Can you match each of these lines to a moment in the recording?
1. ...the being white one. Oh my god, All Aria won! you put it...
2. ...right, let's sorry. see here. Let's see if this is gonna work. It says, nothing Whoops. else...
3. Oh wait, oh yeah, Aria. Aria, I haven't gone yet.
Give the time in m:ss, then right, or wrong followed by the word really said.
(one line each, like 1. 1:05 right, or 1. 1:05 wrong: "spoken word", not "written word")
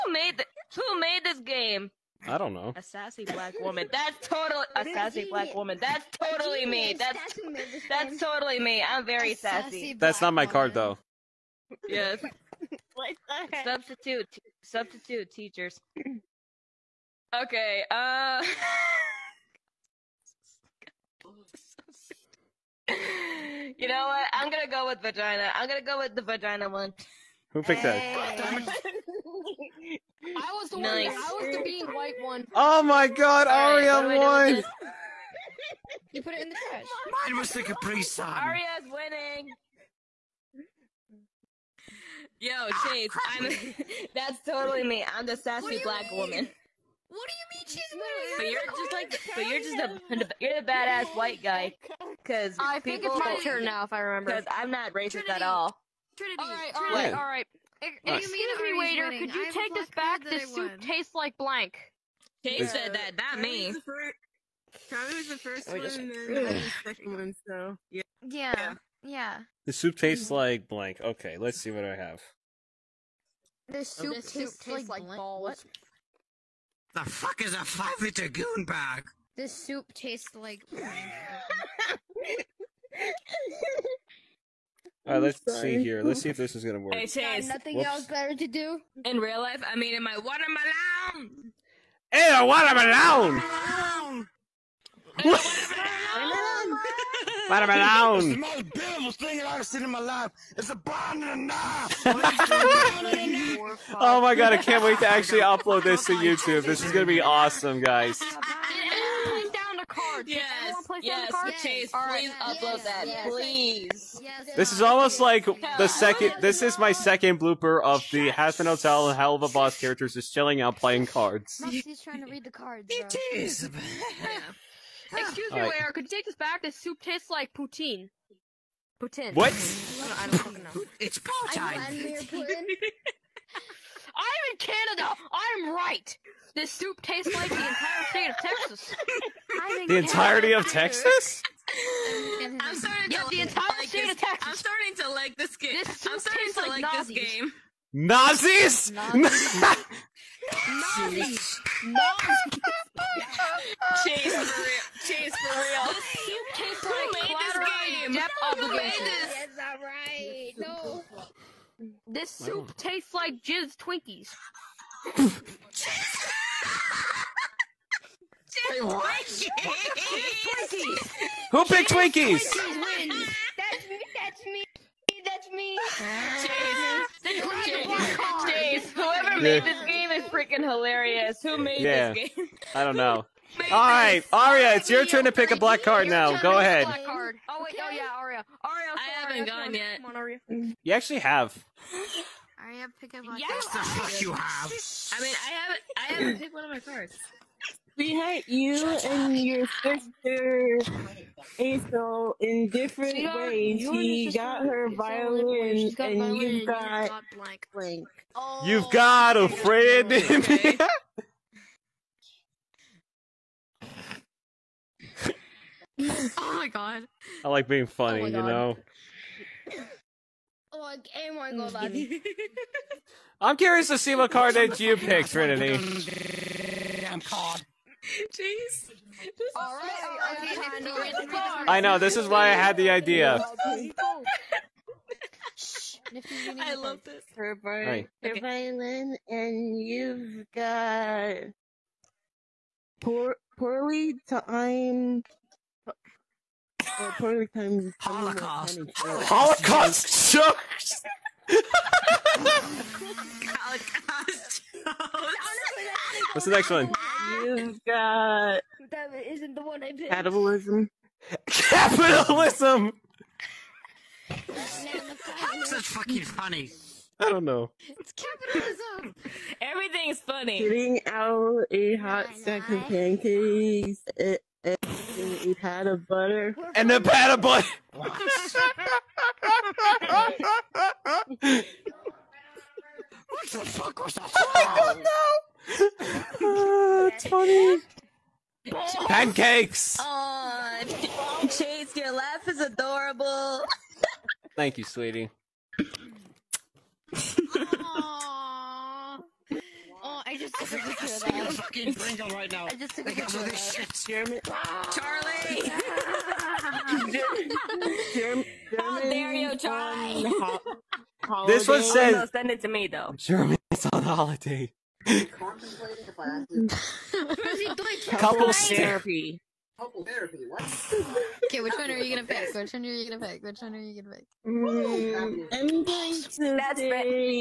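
1. 0:31 right
2. 1:25 right
3. 3:06 right.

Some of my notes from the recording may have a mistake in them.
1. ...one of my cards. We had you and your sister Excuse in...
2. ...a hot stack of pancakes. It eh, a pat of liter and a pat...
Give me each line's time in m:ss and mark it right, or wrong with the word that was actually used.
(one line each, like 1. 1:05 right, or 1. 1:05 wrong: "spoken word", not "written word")
1. 3:16 wrong: "Aisel", not "Excuse"
2. 4:31 wrong: "butter", not "liter".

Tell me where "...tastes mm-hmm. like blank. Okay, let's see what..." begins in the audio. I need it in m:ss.
1:09.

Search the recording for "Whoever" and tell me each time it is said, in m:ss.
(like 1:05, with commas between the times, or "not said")
2:58.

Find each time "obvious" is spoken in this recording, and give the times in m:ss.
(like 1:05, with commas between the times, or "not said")
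not said.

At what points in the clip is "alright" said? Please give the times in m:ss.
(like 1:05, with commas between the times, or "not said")
2:39.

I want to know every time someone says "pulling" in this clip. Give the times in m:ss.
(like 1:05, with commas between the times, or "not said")
not said.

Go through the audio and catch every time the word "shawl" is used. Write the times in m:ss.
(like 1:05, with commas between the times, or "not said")
not said.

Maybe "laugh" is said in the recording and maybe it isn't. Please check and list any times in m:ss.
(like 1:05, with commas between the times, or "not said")
4:52.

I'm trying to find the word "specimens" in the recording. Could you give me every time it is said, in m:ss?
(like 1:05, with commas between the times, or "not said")
not said.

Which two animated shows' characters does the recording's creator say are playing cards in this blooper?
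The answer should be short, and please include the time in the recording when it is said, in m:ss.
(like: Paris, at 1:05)
Hazbin Hotel and Hell of a Boss, at 1:58.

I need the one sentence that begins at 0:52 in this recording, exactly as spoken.
Cause I think people, it's my turn now, if I remember.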